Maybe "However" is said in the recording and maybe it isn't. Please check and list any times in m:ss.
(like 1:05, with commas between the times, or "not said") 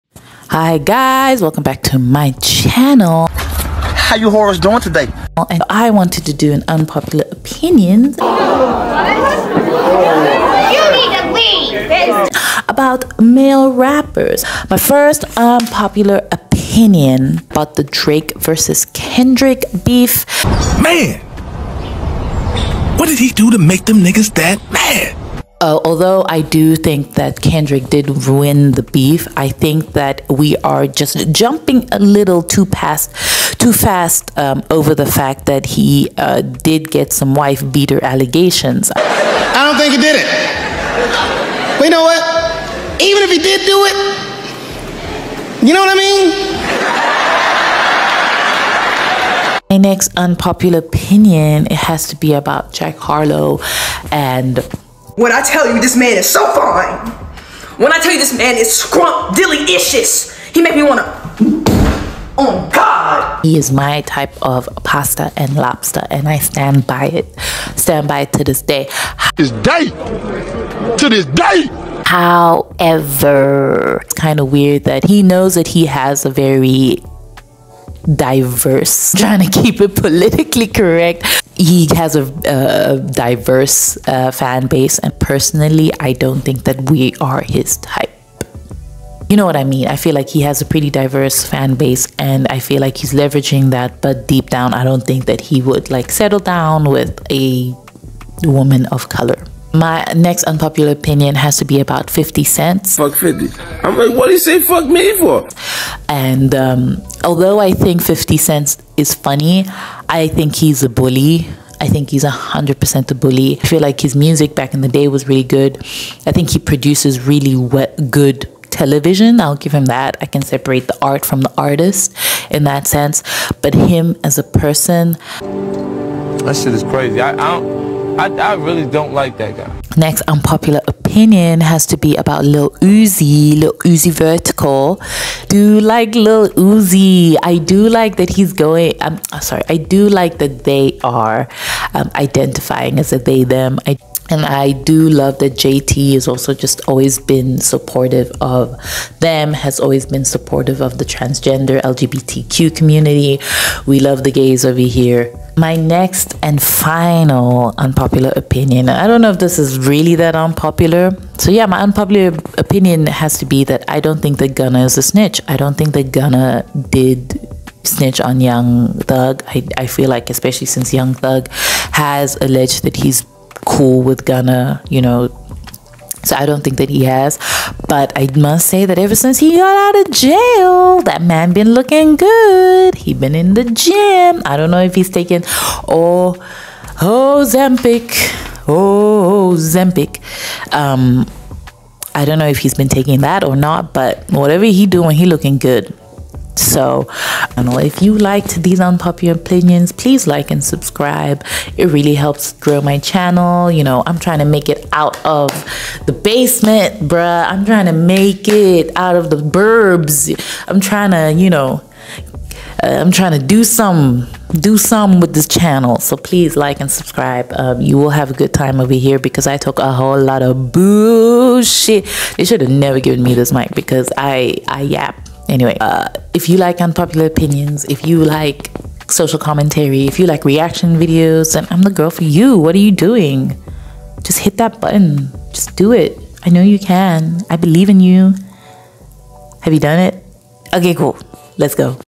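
1:12.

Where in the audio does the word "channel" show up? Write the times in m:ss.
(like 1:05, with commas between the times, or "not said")
0:02, 3:22, 3:35.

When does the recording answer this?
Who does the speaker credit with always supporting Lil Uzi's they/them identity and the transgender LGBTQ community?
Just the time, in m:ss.
2:25.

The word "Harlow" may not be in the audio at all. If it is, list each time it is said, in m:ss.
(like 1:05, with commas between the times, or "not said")
0:52.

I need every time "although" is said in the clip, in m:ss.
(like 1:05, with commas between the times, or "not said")
0:25, 1:47.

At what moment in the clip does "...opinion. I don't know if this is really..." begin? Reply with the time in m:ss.
2:38.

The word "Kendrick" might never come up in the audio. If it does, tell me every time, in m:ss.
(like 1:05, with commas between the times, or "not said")
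0:18, 0:27.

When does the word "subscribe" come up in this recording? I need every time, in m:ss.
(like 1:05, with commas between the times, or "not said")
3:20, 3:36.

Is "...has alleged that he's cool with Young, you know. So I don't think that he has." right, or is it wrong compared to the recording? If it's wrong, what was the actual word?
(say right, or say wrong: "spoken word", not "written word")
wrong: "Gunna", not "Young".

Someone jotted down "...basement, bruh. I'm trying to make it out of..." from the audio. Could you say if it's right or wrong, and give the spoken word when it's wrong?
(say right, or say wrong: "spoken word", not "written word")
right.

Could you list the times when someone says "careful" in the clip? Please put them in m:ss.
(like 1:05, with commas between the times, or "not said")
not said.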